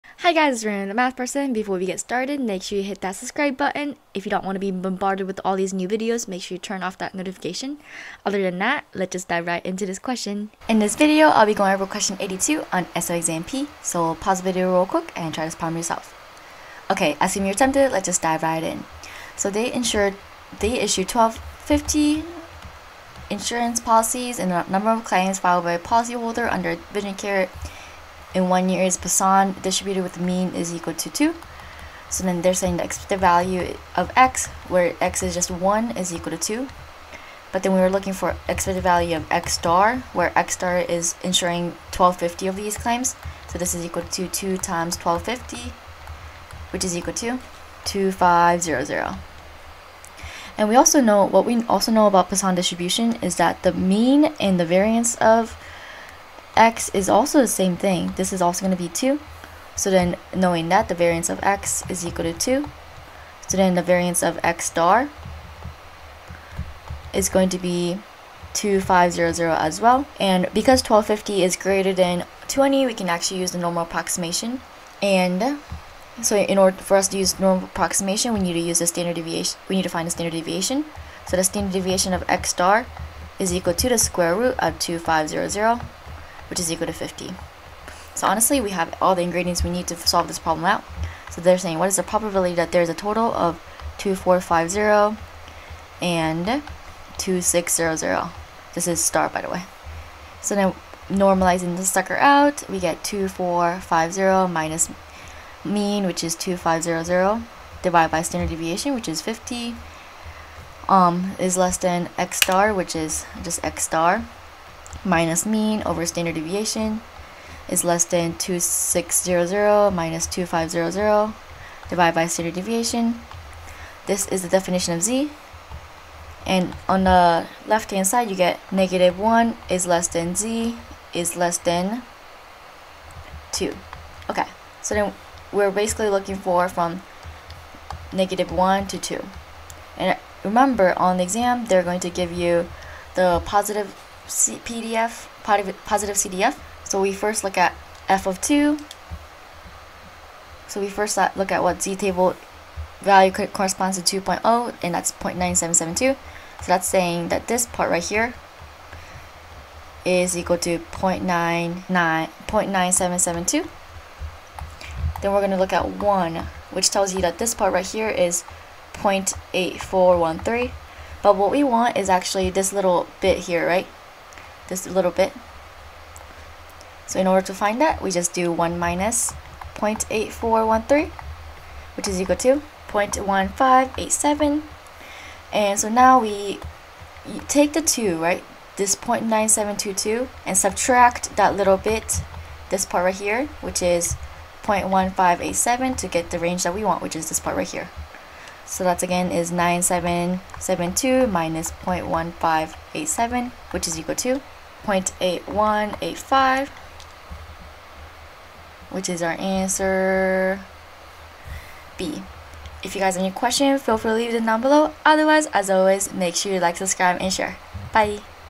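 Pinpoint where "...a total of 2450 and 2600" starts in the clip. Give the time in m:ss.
1:32.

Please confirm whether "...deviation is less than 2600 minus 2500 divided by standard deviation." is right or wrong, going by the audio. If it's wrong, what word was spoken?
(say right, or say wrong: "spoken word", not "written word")
right.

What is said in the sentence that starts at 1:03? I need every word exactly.
So then the variance of x star is going to be 2500 as well.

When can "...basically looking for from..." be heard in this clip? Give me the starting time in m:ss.
2:15.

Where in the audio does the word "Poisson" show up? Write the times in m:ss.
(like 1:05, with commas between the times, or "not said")
0:28, 0:52.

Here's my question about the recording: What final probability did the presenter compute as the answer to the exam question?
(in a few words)
0.8185.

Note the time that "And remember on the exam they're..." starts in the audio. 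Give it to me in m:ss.
2:19.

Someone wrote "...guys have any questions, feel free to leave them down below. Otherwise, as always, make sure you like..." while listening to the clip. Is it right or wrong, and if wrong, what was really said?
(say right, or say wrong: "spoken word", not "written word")
right.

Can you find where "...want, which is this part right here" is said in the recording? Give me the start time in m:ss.
3:16.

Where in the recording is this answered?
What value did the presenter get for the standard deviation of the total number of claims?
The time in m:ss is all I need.
1:26.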